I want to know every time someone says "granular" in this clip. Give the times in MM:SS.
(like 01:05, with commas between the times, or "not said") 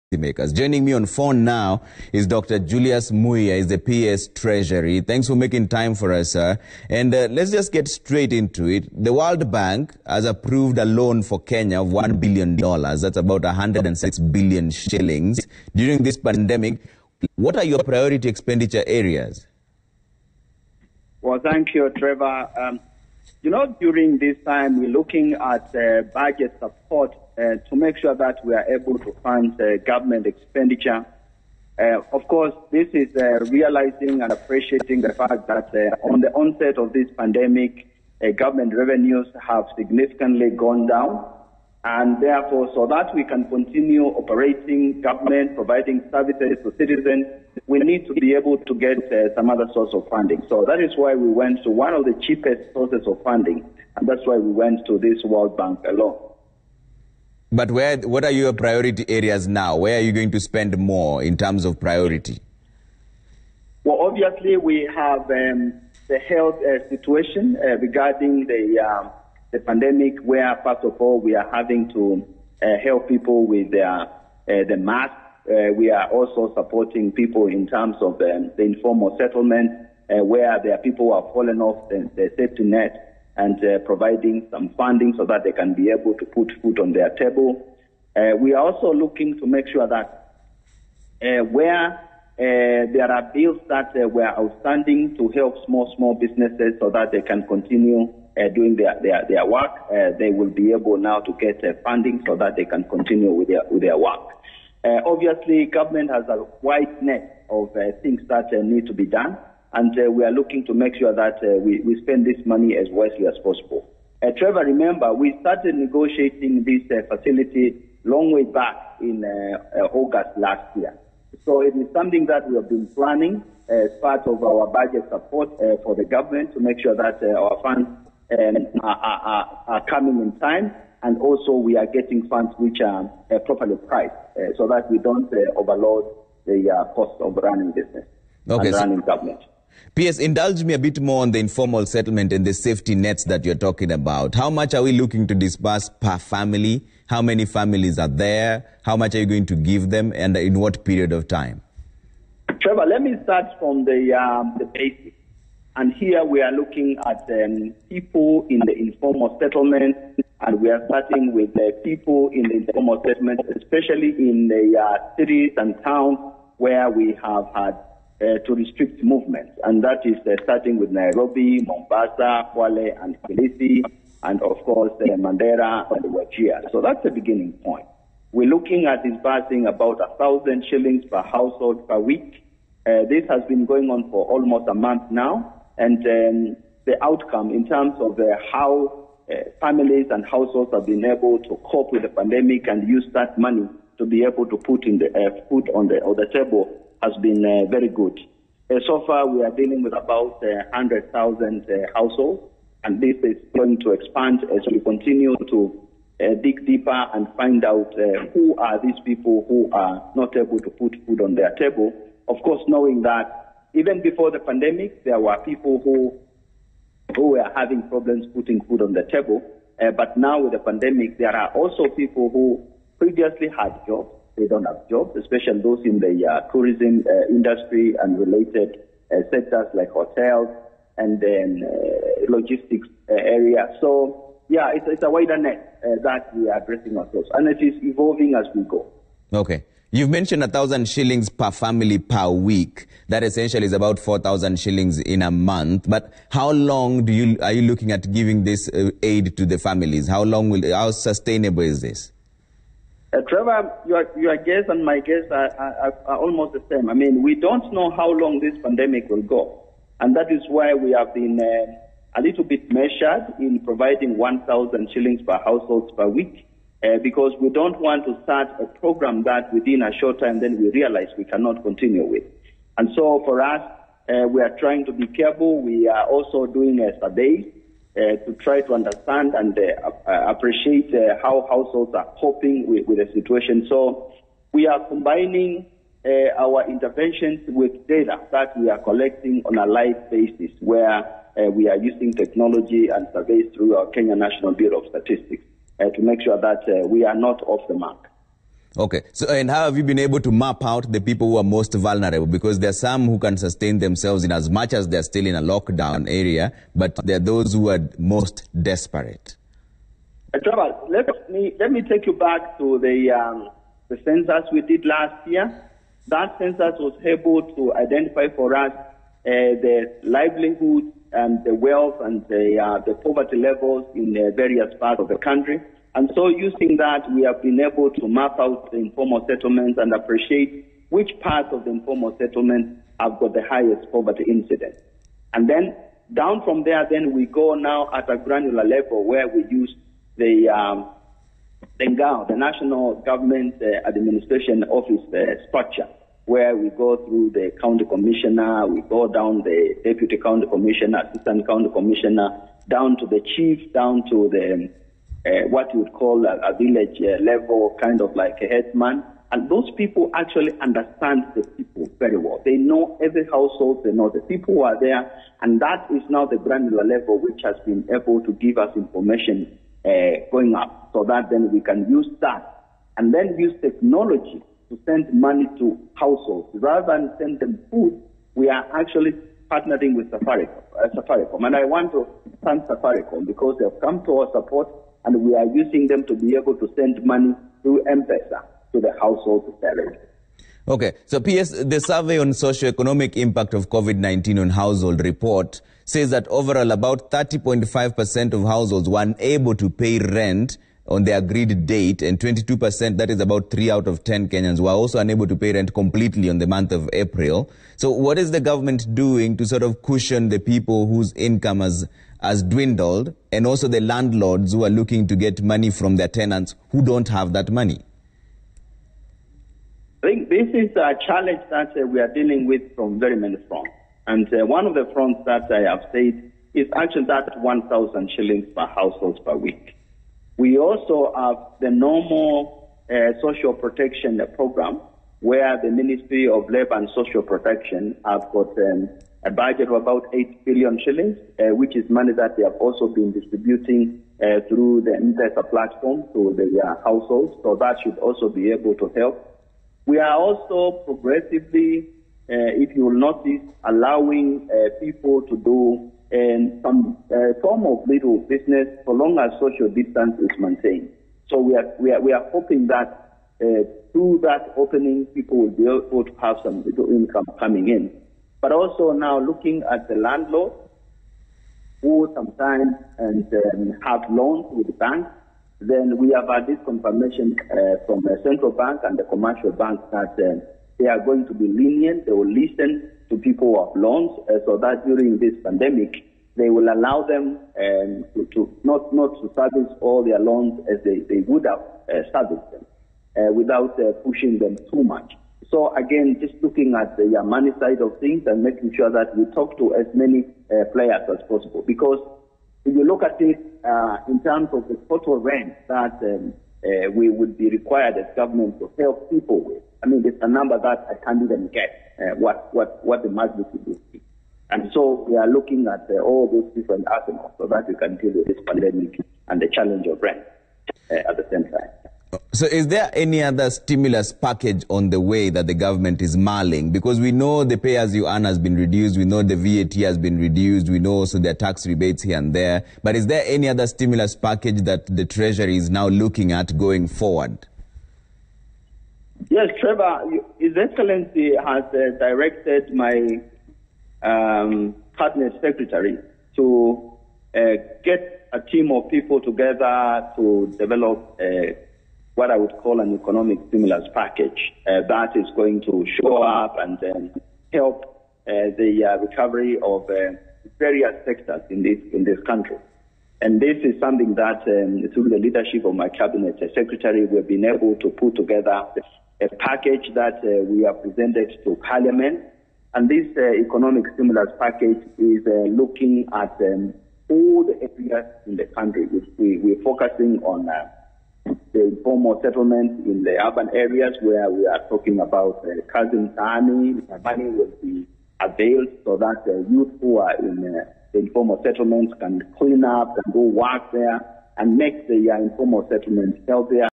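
05:38, 06:06.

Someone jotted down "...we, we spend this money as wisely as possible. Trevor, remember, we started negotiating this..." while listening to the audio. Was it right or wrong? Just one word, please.
right.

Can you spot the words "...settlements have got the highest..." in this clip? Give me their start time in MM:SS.
05:32.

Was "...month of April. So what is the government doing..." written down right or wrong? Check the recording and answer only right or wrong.
right.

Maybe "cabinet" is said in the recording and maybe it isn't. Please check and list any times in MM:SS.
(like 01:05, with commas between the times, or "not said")
09:04, 09:25.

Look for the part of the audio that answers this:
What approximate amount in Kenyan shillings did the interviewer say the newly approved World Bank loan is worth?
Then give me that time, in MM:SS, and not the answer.
00:13.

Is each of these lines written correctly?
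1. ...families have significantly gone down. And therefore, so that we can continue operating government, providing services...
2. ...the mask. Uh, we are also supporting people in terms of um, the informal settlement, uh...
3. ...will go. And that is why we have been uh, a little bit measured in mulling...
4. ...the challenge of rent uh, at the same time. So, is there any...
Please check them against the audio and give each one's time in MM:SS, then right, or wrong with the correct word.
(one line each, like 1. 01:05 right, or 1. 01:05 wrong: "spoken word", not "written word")
1. 00:38 wrong: "revenues", not "families"
2. 01:14 right
3. 04:19 wrong: "providing", not "mulling"
4. 08:39 right.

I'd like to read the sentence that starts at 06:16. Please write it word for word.
Rather than send them food, we are actually partnering with Safaricom, uh, Safaricom.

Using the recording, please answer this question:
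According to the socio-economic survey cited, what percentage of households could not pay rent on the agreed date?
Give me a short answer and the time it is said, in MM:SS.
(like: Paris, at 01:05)
30.5%, at 06:37.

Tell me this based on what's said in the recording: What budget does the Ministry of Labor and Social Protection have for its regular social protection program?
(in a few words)
8 billion shillings.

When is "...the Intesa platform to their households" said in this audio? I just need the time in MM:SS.
07:24.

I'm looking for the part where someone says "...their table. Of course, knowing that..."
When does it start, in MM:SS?
03:31.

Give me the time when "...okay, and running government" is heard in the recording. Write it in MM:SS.
02:18.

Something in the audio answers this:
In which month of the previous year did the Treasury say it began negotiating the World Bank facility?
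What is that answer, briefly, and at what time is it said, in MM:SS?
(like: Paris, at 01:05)
August, at 01:59.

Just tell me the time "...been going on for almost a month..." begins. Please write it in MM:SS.
03:03.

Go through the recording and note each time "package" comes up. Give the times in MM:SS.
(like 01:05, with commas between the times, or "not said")
08:44, 08:54, 09:13, 09:29, 09:34.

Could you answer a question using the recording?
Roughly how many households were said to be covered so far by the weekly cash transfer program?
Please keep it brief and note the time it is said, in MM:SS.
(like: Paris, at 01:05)
100,000, at 03:20.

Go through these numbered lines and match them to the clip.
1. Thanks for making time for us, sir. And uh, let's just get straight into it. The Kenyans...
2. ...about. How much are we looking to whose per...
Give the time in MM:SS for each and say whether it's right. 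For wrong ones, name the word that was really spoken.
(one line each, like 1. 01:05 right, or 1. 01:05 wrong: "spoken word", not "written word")
1. 00:05 wrong: "World", not "Kenyans"
2. 02:23 wrong: "disperse", not "whose".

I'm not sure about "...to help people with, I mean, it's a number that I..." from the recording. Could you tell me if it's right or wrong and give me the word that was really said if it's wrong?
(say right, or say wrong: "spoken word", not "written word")
right.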